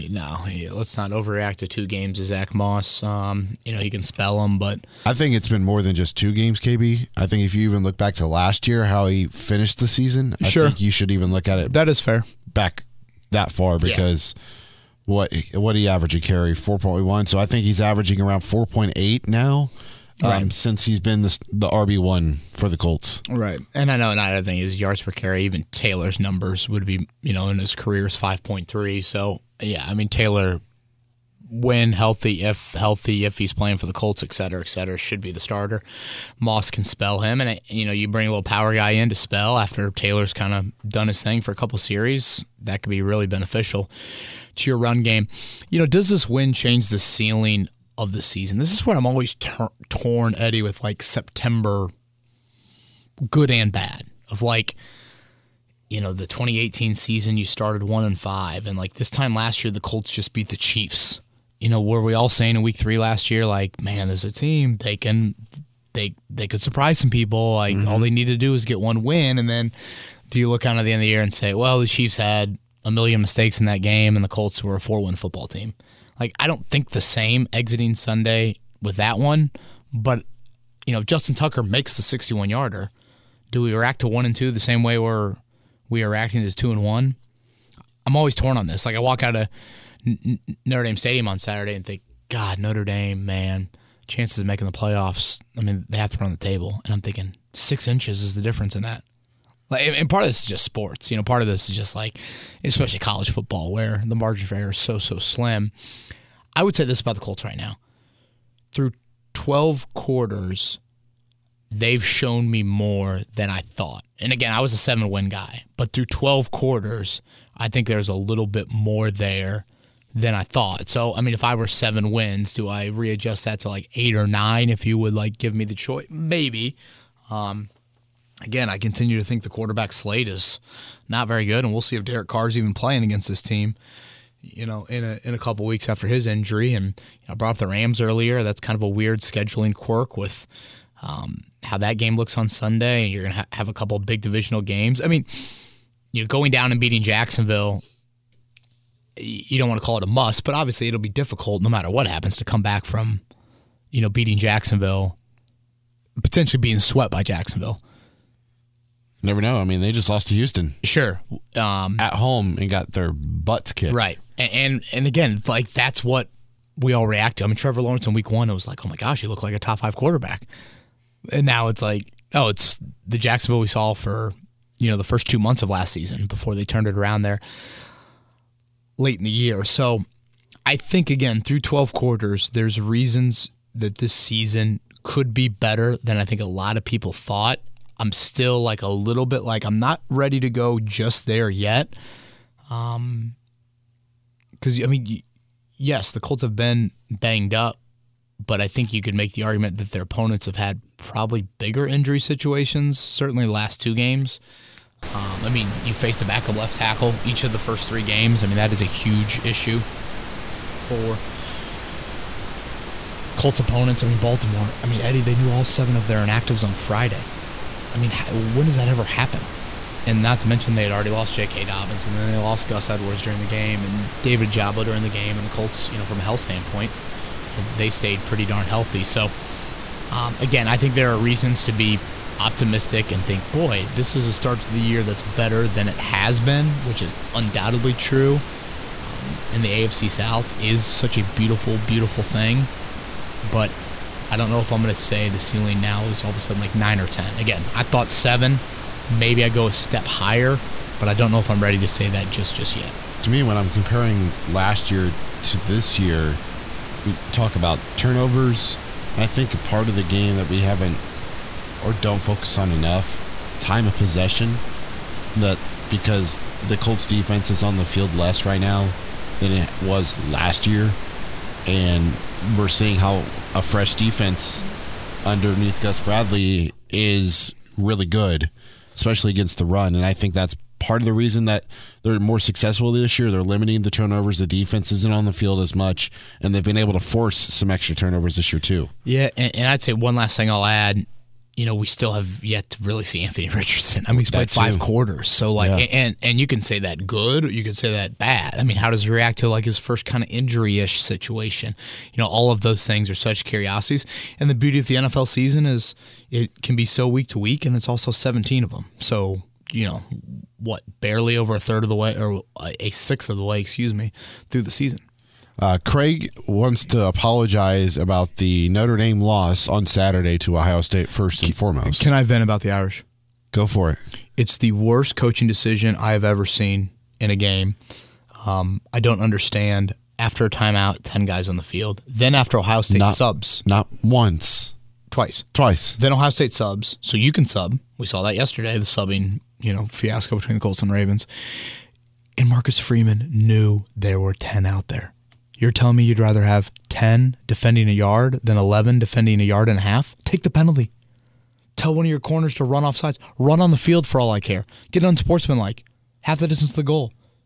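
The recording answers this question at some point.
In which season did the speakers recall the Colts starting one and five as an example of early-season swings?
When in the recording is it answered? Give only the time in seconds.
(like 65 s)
56 s.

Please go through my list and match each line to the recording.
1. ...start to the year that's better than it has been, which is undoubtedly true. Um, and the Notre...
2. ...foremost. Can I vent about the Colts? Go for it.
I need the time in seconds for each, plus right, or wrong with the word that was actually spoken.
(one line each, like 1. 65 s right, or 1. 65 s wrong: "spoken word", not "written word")
1. 234 s wrong: "AFC", not "Notre"
2. 321 s wrong: "Irish", not "Colts".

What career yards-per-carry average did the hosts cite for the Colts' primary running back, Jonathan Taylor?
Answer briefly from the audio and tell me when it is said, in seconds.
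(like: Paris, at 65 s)
5.3, at 28 s.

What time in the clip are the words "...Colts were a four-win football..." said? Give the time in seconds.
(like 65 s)
74 s.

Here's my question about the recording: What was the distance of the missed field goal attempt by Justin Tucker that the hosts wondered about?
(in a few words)
61 yards.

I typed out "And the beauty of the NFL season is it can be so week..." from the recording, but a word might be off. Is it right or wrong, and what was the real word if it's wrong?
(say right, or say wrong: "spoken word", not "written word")
right.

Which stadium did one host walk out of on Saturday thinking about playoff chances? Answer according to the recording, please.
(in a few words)
Notre Dame Stadium.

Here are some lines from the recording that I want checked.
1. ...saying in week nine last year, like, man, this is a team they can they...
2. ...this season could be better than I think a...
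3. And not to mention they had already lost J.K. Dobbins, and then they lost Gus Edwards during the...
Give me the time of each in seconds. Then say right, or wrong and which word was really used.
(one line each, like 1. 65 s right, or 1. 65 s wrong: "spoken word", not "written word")
1. 62 s wrong: "three", not "nine"
2. 183 s right
3. 220 s right.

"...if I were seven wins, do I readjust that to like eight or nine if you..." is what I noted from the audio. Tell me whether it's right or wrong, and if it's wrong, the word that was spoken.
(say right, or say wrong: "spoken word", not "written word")
right.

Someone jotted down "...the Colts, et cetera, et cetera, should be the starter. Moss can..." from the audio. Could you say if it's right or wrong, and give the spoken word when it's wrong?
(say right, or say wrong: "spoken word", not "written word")
right.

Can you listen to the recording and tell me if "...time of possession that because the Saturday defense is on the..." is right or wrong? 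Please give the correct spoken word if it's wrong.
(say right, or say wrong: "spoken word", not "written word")
wrong: "Colts", not "Saturday".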